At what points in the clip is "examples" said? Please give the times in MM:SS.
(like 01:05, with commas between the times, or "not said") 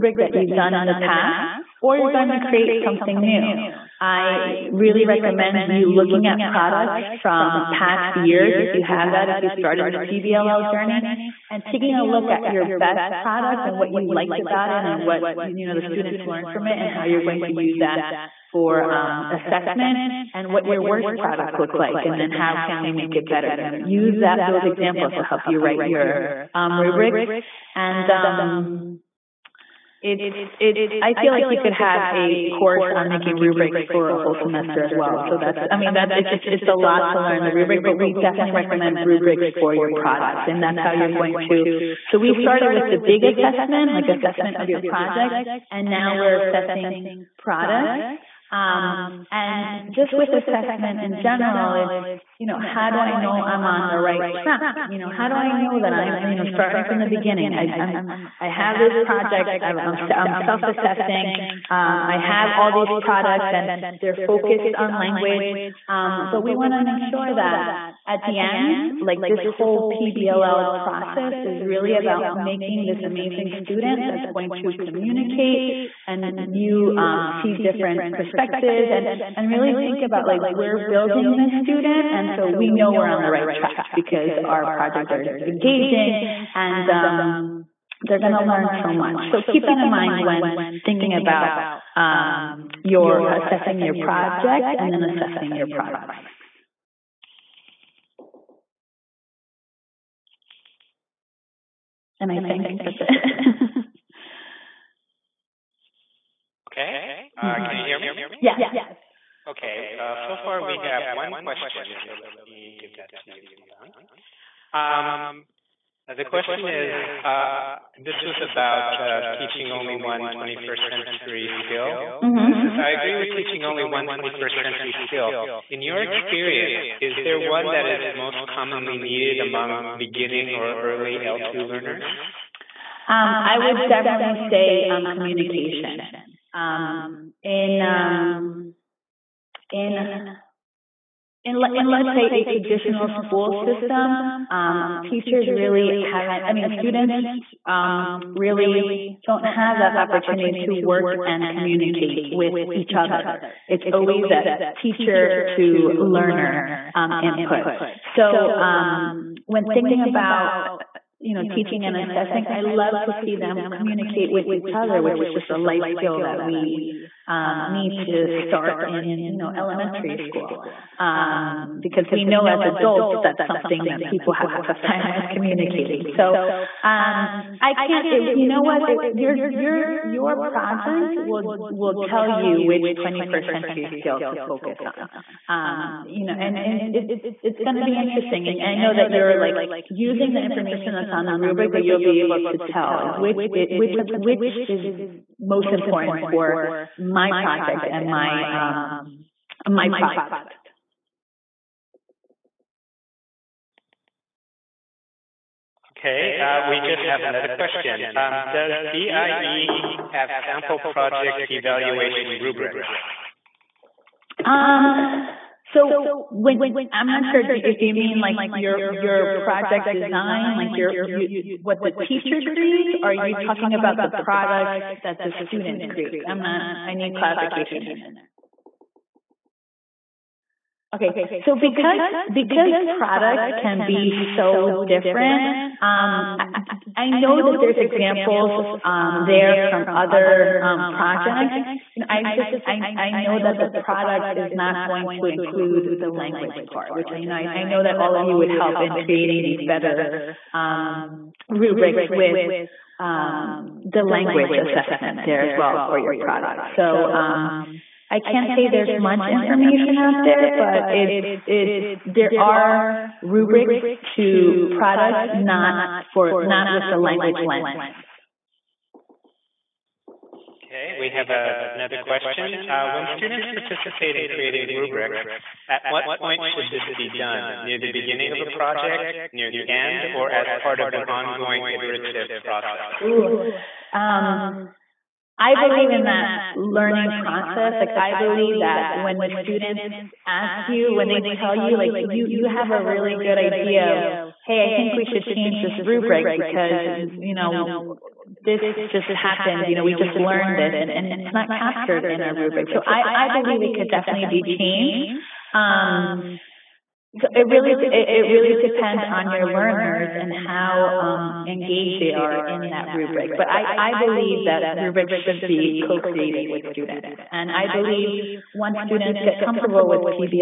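00:24, 03:57.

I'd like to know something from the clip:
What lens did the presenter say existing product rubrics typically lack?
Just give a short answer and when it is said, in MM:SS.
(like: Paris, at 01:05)
language lens, at 04:26.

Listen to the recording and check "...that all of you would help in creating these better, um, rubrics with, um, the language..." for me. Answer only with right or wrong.
right.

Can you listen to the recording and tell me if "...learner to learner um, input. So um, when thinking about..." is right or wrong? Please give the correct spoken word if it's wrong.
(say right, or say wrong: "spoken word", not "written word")
wrong: "teacher", not "learner".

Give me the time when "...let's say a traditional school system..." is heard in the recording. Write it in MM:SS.
02:21.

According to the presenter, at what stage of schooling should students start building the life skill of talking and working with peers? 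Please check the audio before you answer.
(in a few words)
elementary school.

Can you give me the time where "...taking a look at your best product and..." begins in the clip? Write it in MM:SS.
00:11.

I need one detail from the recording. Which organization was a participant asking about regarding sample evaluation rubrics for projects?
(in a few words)
BIE.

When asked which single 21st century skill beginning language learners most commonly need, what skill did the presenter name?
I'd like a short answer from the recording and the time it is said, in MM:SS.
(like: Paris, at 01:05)
communication, at 02:15.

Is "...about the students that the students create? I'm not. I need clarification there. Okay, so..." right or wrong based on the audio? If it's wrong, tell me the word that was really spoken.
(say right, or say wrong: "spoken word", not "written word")
wrong: "products", not "students".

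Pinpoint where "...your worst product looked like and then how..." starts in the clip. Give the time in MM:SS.
00:20.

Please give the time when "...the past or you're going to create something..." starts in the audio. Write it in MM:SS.
00:00.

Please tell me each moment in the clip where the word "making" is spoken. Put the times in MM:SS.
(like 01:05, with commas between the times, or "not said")
00:33, 01:12.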